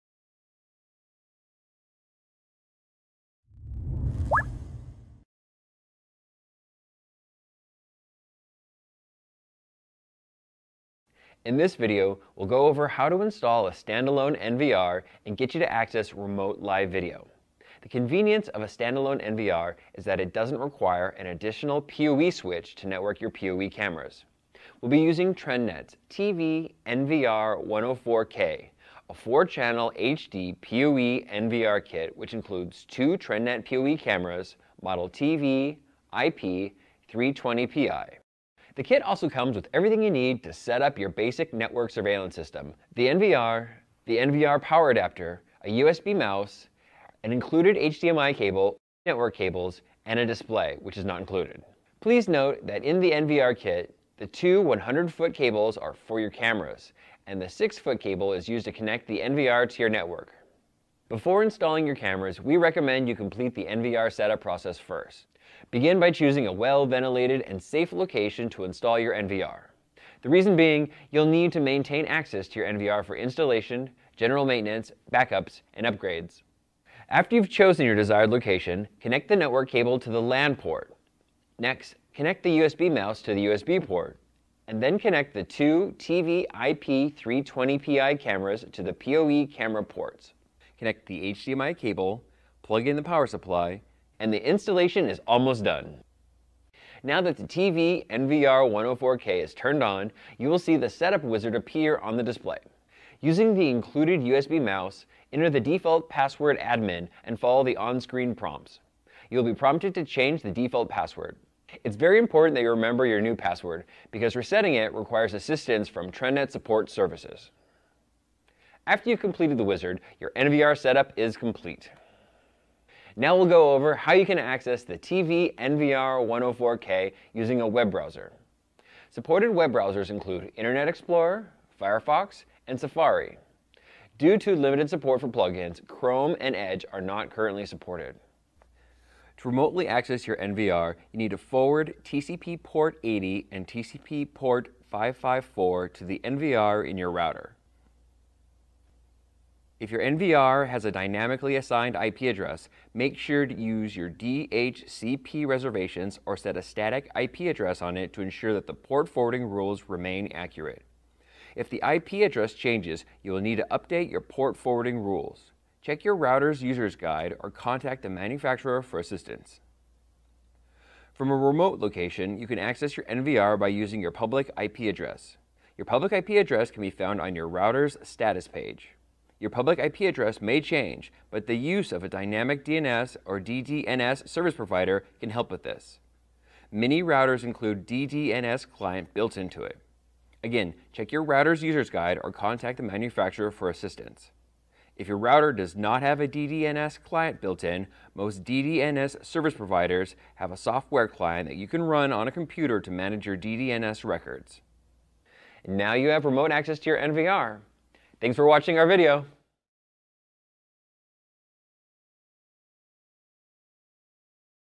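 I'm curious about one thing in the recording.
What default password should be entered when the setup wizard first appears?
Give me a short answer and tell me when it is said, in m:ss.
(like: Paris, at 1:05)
admin, at 1:46.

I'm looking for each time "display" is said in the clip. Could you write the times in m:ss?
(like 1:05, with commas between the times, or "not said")
0:50, 1:42.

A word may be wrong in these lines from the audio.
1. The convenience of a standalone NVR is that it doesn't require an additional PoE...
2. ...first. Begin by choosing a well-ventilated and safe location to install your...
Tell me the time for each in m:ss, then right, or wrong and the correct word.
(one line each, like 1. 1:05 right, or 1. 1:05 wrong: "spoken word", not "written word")
1. 0:17 right
2. 1:04 right.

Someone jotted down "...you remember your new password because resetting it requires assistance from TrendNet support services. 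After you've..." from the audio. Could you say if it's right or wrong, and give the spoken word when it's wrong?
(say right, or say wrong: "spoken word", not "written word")
right.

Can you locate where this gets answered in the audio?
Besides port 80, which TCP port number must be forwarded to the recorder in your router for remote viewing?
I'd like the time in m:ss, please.
2:24.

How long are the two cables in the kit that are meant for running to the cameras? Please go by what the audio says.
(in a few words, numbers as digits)
100 feet.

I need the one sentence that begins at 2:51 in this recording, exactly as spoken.
From a remote location, you can access your NVR by using your public IP address.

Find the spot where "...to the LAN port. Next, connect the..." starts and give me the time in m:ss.
1:19.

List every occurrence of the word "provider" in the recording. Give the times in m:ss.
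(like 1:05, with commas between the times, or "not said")
3:04, 3:19.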